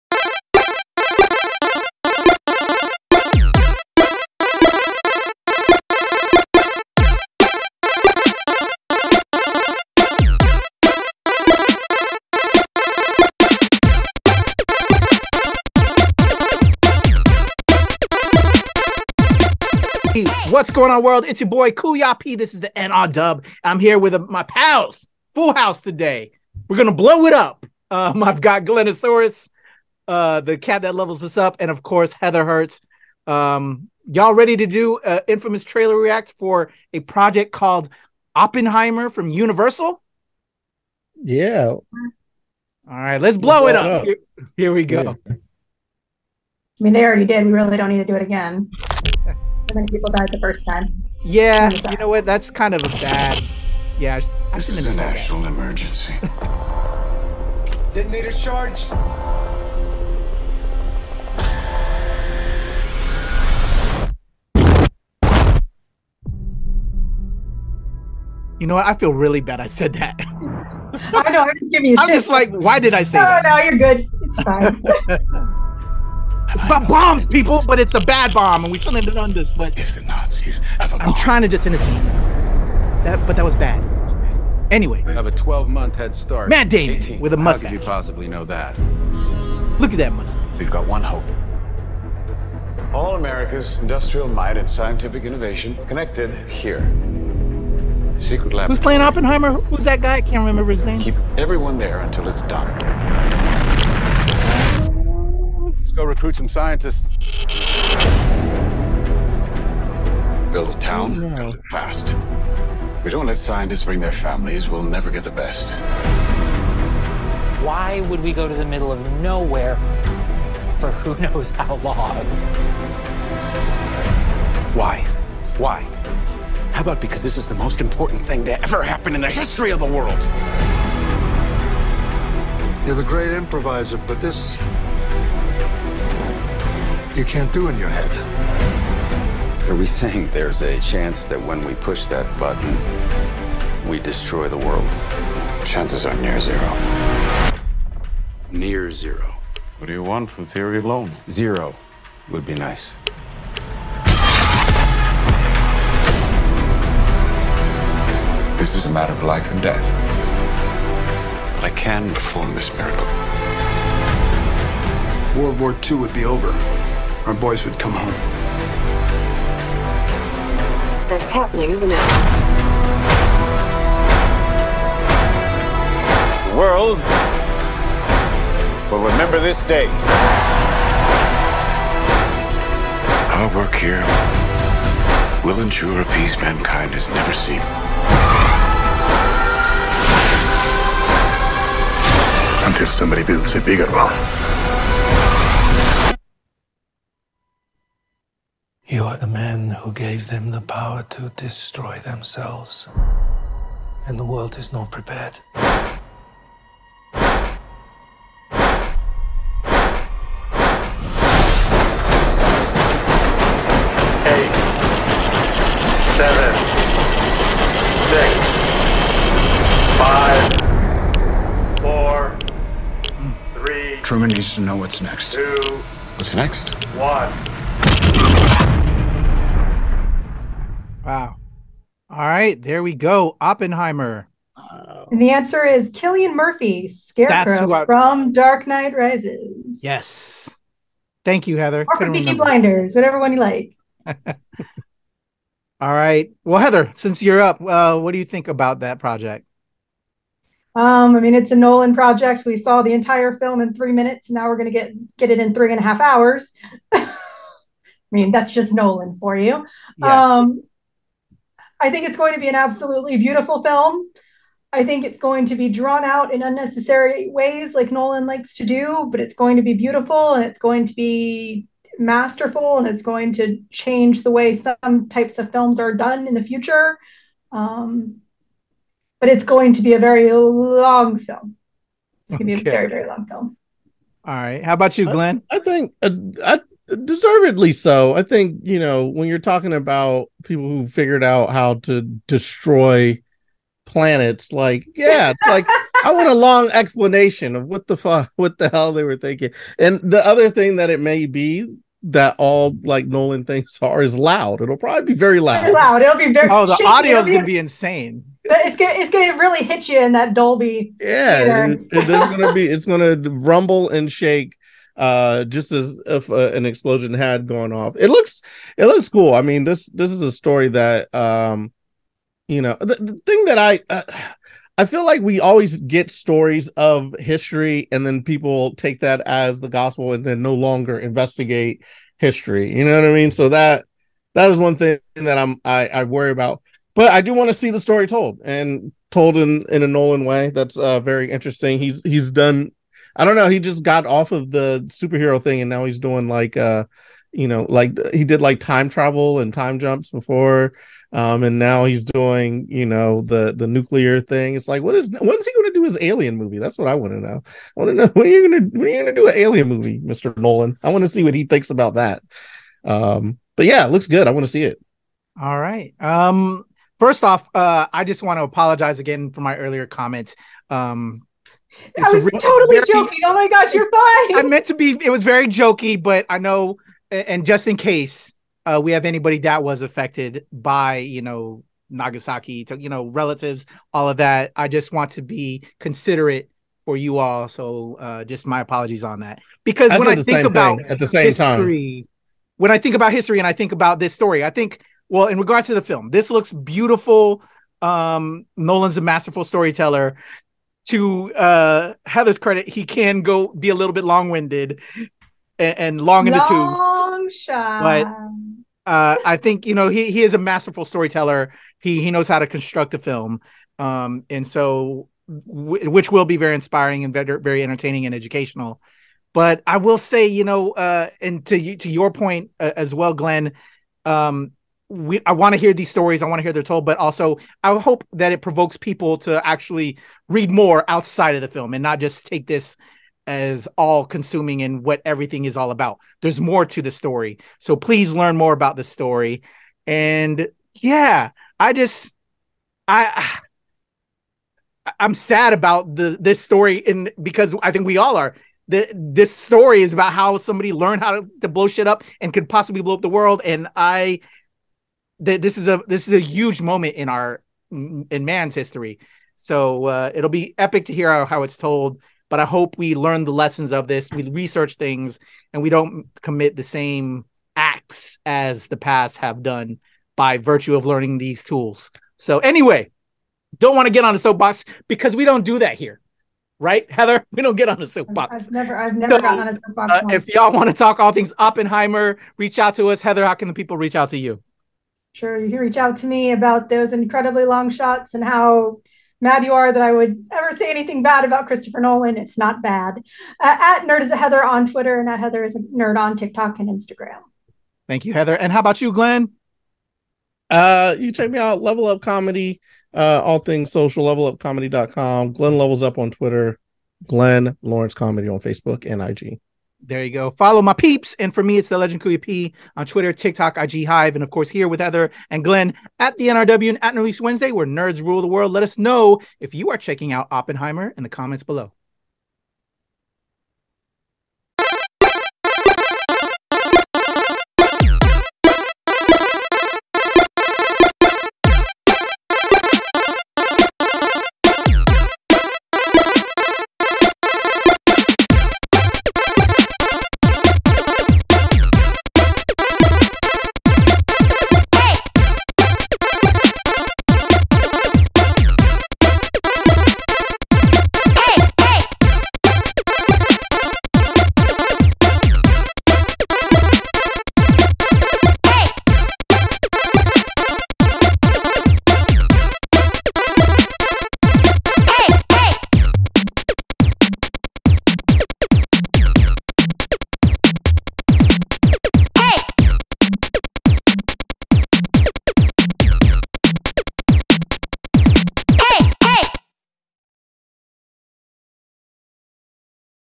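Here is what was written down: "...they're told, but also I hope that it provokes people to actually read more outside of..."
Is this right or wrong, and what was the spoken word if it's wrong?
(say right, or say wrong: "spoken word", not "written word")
right.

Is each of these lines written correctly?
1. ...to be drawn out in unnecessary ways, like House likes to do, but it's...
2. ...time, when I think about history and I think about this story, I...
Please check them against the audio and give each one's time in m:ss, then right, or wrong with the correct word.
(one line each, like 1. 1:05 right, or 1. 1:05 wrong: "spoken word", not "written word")
1. 4:25 wrong: "Nolan", not "House"
2. 6:32 right.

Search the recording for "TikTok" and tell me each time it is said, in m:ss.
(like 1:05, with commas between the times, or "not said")
8:16, 8:33.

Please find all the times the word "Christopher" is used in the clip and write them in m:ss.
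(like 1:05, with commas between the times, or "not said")
8:11.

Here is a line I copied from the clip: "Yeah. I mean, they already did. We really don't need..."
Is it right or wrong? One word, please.
right.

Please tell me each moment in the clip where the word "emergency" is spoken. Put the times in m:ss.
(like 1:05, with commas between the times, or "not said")
0:55.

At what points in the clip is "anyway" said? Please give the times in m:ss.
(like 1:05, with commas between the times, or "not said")
1:24, 7:52.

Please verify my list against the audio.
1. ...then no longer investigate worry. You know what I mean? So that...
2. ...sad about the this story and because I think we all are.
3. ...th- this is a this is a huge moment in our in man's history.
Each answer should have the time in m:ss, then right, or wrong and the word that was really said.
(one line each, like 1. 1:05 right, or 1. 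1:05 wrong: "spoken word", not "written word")
1. 5:30 wrong: "history", not "worry"
2. 7:25 right
3. 7:35 right.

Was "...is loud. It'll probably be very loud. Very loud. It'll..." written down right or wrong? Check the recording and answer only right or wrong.
right.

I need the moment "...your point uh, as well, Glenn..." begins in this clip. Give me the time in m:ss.
7:01.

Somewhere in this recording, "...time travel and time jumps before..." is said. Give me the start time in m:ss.
5:48.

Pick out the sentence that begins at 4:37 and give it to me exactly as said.
Um, but it's going to be a very long film.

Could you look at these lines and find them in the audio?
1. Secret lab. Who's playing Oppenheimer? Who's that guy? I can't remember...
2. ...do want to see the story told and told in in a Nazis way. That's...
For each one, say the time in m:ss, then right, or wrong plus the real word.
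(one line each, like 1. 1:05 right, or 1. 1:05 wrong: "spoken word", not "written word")
1. 1:38 right
2. 5:37 wrong: "Nolan", not "Nazis".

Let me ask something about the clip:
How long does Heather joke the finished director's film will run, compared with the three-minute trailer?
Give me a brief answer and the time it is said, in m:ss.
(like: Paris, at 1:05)
Three and a half hours, at 4:15.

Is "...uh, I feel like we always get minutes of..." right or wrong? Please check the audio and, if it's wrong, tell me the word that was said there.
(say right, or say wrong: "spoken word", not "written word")
wrong: "stories", not "minutes".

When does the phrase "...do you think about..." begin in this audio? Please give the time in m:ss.
4:08.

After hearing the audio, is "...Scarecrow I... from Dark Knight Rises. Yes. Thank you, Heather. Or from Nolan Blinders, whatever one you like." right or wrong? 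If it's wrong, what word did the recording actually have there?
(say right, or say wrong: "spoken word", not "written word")
wrong: "Peaky", not "Nolan".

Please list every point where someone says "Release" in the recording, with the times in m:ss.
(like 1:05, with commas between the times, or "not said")
8:36.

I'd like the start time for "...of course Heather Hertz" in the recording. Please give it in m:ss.
0:31.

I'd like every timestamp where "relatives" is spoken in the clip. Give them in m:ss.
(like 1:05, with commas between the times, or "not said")
6:23.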